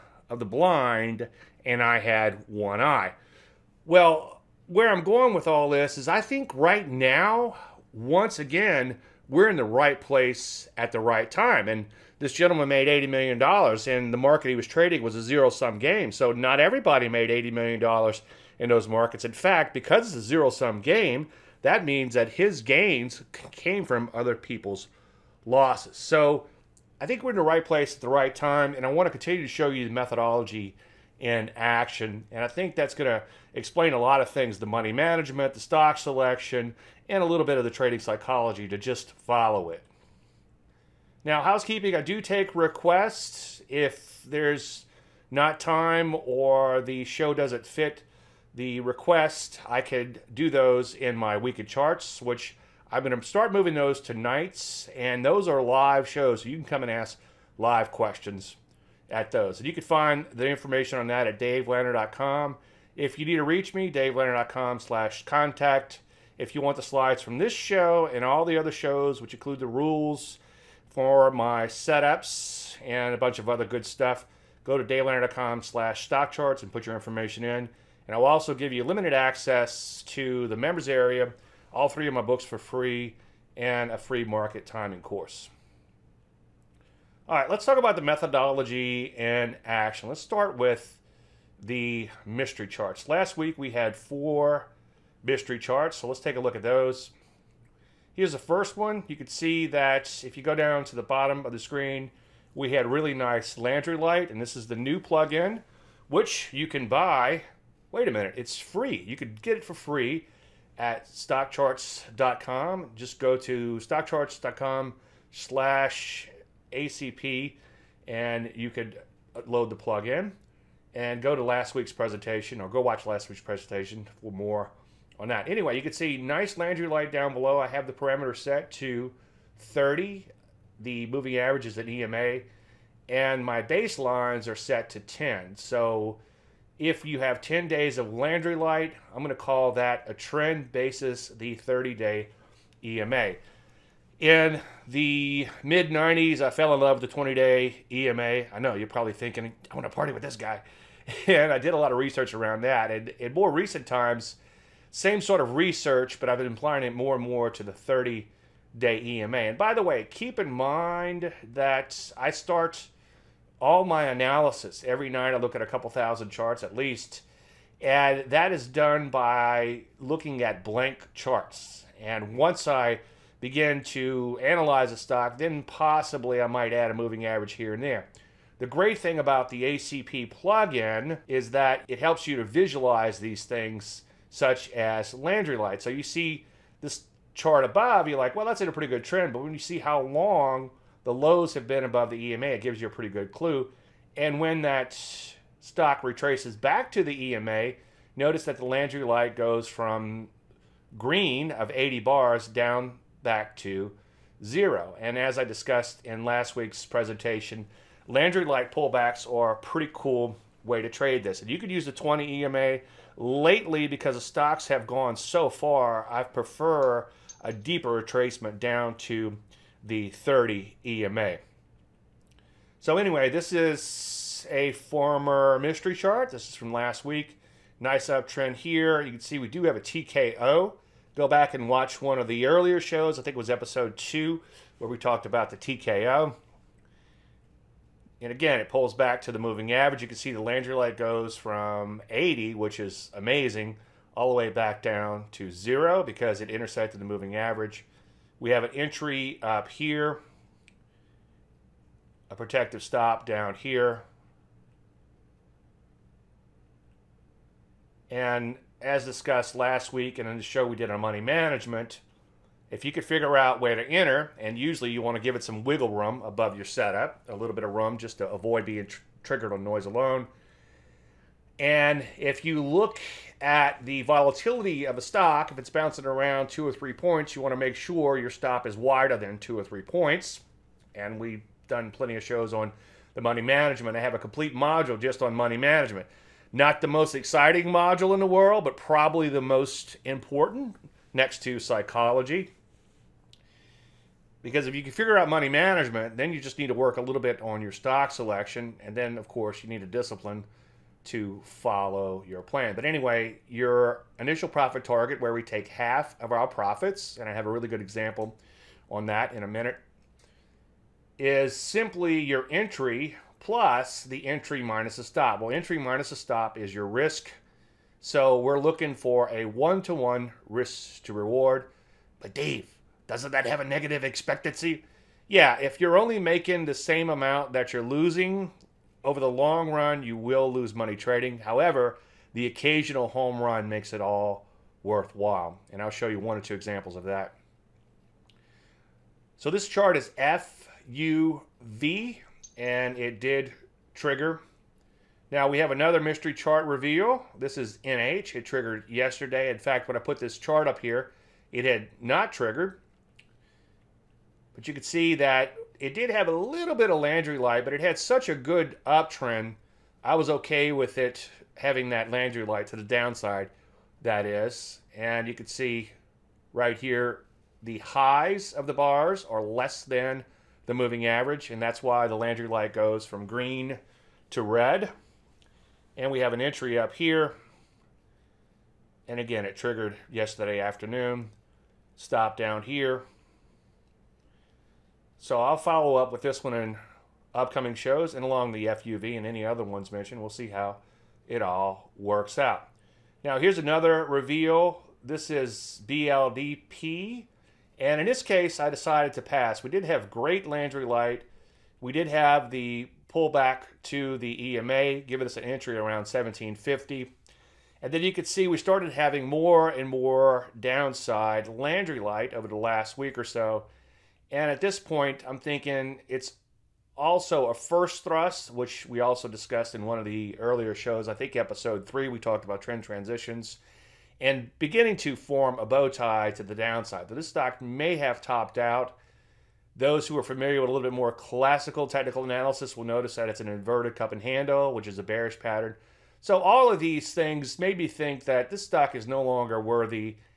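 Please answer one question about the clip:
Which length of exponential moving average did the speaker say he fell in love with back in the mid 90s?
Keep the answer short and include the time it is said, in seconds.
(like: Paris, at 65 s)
20 day EMA, at 147 s.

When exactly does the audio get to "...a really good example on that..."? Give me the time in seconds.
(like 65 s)
307 s.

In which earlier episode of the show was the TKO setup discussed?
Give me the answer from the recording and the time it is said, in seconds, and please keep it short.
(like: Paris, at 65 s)
episode two, at 233 s.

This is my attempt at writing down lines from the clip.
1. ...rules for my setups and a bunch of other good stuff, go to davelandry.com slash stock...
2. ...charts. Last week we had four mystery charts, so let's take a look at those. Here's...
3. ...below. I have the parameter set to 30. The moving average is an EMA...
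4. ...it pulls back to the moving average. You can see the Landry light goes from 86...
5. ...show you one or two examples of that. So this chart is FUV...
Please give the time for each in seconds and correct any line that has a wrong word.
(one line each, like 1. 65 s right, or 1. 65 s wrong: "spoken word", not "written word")
1. 69 s right
2. 92 s right
3. 127 s right
4. 238 s wrong: "80", not "86"
5. 335 s right.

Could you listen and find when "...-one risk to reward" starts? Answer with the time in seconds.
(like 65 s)
320 s.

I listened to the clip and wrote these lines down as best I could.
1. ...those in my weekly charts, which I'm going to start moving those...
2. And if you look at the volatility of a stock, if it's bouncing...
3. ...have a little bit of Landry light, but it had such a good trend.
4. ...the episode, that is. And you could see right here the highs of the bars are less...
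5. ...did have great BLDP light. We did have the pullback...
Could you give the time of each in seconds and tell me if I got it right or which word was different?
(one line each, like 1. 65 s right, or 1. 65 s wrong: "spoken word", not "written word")
1. 50 s right
2. 271 s right
3. 356 s wrong: "uptrend", not "trend"
4. 362 s wrong: "downside", not "episode"
5. 399 s wrong: "Landry", not "BLDP".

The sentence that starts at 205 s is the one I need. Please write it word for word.
And as I discussed in last week's presentation, Landry Light pullbacks are a pretty cool way to trade this.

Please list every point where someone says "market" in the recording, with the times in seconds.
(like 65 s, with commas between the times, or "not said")
14 s, 18 s, 84 s.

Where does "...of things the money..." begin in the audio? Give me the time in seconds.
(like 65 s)
34 s.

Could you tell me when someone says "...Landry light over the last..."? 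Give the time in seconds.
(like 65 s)
411 s.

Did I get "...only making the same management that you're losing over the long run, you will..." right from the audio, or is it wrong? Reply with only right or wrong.
wrong.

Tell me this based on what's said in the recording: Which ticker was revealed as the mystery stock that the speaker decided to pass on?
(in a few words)
BLDP.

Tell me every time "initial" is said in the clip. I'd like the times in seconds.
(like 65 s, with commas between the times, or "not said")
304 s.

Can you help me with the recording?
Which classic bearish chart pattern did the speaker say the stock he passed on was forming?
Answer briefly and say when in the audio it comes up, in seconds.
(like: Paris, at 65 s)
inverted cup and handle, at 433 s.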